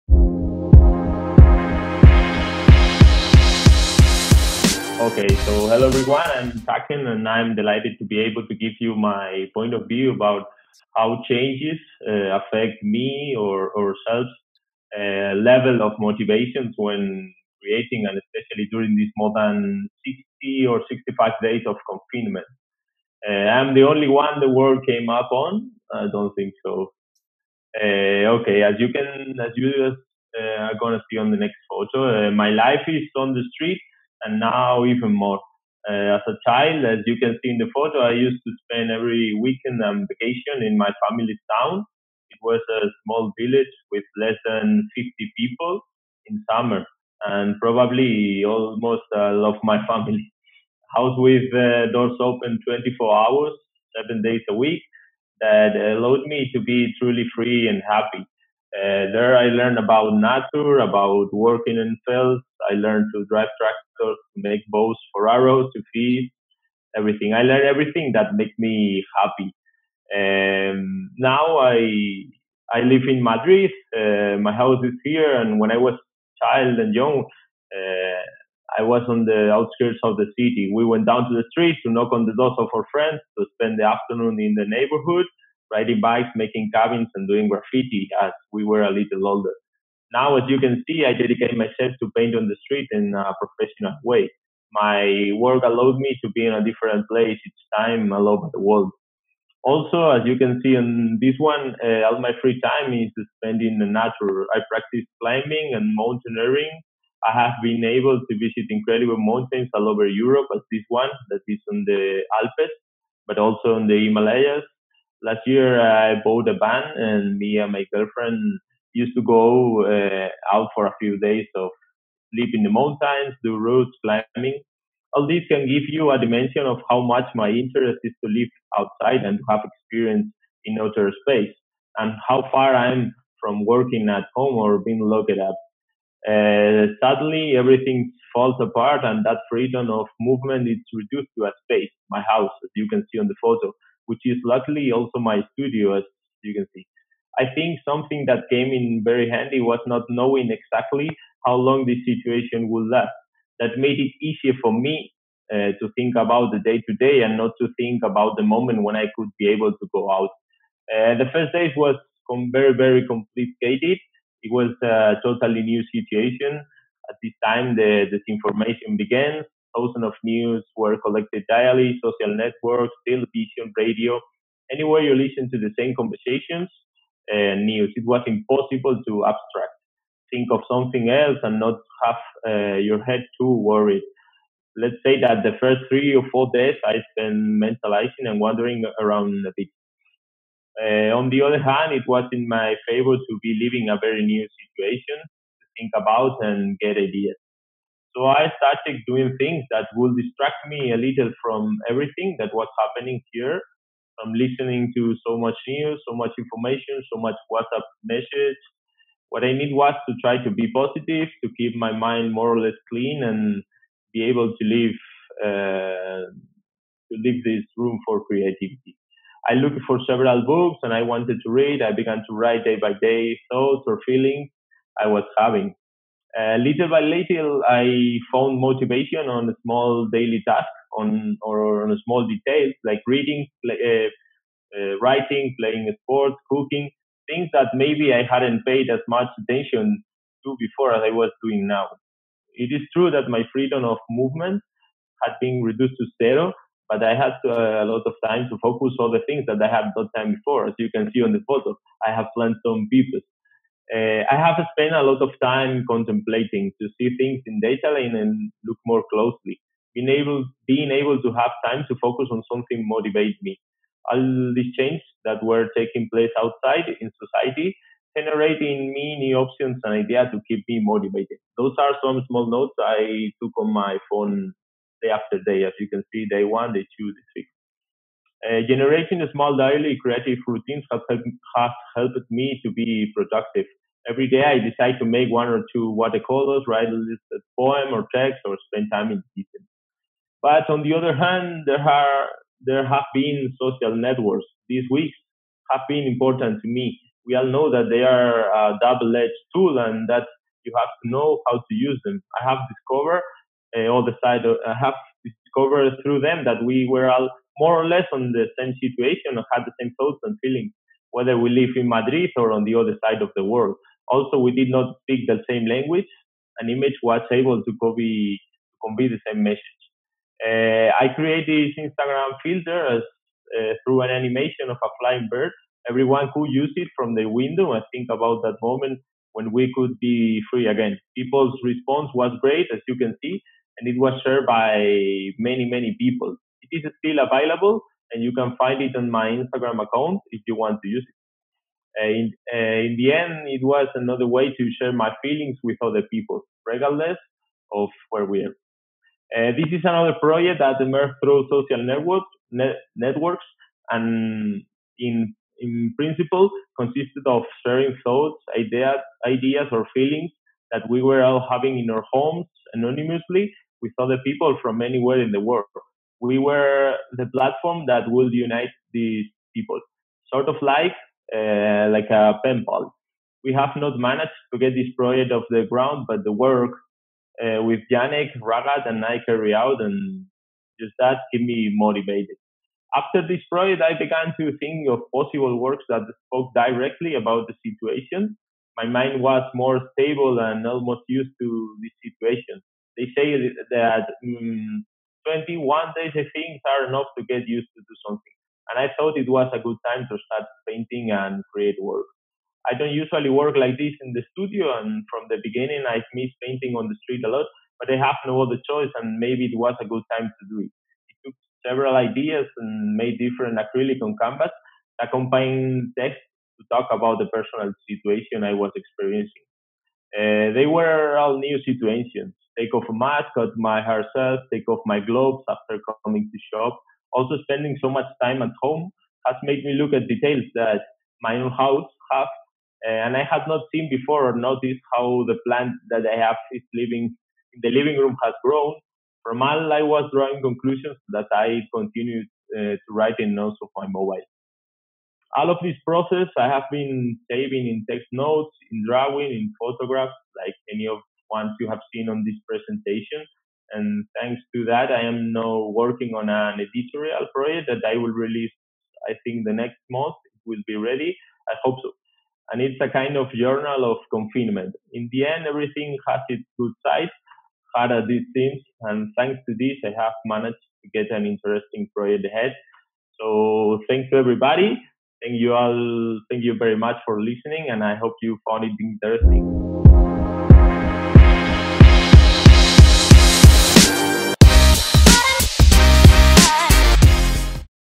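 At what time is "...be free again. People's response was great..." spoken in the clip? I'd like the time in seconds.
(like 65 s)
330 s.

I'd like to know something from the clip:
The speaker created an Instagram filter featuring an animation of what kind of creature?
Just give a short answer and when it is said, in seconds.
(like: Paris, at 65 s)
a flying bird, at 324 s.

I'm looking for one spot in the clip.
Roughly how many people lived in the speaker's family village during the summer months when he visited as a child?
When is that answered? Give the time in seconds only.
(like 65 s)
44 s.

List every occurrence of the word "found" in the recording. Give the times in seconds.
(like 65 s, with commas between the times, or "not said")
228 s, 478 s.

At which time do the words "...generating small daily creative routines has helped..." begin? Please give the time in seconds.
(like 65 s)
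278 s.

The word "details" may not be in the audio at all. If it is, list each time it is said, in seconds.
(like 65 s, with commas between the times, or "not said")
232 s, 430 s.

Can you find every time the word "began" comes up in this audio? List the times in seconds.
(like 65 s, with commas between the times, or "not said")
168 s, 221 s, 383 s.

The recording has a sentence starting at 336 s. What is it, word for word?
It is still available, and you can find it on my Instagram account if you want to use it.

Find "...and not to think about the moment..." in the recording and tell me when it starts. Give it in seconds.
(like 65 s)
157 s.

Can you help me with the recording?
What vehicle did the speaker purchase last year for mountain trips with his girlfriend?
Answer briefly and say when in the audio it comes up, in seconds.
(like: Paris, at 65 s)
a van, at 116 s.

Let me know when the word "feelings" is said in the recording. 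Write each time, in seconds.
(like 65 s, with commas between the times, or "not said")
224 s, 310 s, 345 s, 359 s.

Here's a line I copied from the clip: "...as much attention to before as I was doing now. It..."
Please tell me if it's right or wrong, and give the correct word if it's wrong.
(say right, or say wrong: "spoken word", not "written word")
right.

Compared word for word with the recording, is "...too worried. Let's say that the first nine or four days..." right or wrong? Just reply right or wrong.
wrong.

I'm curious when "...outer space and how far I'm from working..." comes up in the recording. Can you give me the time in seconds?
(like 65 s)
130 s.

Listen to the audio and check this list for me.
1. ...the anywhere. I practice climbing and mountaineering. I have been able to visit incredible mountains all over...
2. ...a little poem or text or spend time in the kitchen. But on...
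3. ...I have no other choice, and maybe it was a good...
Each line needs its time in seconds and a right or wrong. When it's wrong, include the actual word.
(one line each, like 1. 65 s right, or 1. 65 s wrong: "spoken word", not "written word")
1. 103 s wrong: "nature", not "anywhere"
2. 286 s right
3. 407 s right.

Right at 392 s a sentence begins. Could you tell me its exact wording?
They say that um, 21 days, I think, are enough to get used to do something.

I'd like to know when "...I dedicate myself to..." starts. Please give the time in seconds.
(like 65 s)
91 s.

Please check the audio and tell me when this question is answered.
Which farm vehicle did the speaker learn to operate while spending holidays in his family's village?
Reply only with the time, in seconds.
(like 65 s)
63 s.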